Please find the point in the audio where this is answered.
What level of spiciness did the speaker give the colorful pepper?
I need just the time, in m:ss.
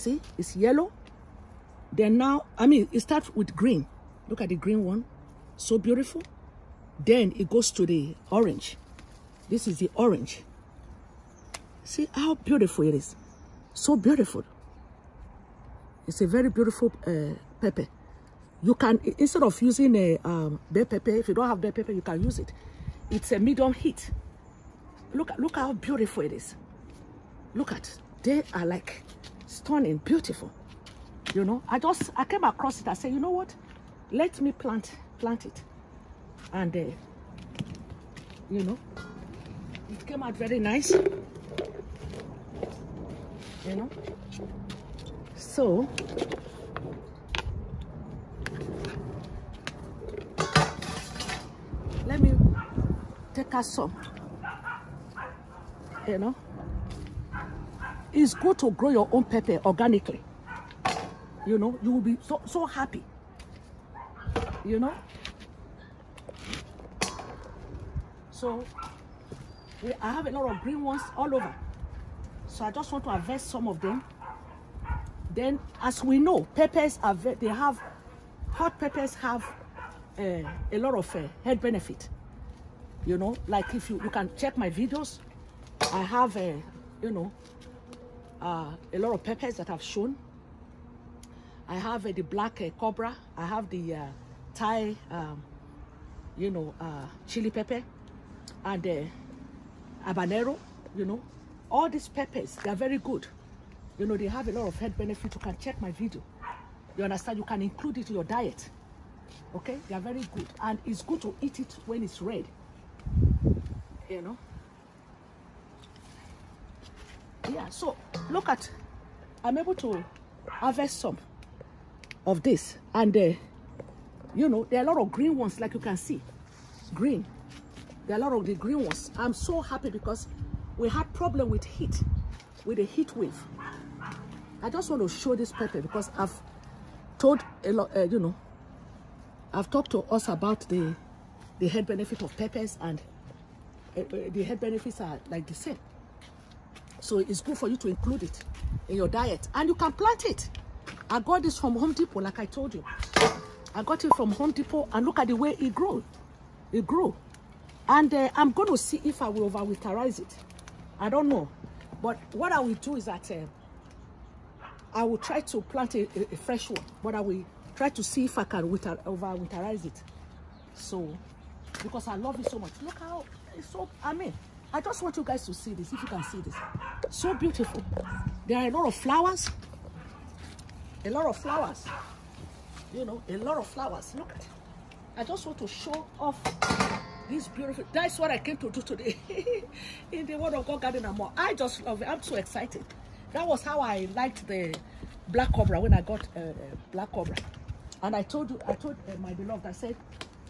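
0:23.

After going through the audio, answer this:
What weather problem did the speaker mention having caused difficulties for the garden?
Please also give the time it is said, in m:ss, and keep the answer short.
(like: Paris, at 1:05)
A heat wave, at 2:12.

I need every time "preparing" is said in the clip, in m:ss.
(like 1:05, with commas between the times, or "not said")
not said.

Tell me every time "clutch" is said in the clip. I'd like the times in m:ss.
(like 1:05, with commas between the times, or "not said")
not said.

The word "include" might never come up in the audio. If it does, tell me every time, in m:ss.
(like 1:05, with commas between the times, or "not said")
1:47, 2:27.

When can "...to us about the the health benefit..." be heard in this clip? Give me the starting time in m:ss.
2:19.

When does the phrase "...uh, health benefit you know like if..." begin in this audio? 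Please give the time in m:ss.
1:21.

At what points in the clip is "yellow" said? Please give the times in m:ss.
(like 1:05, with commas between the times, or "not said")
0:00.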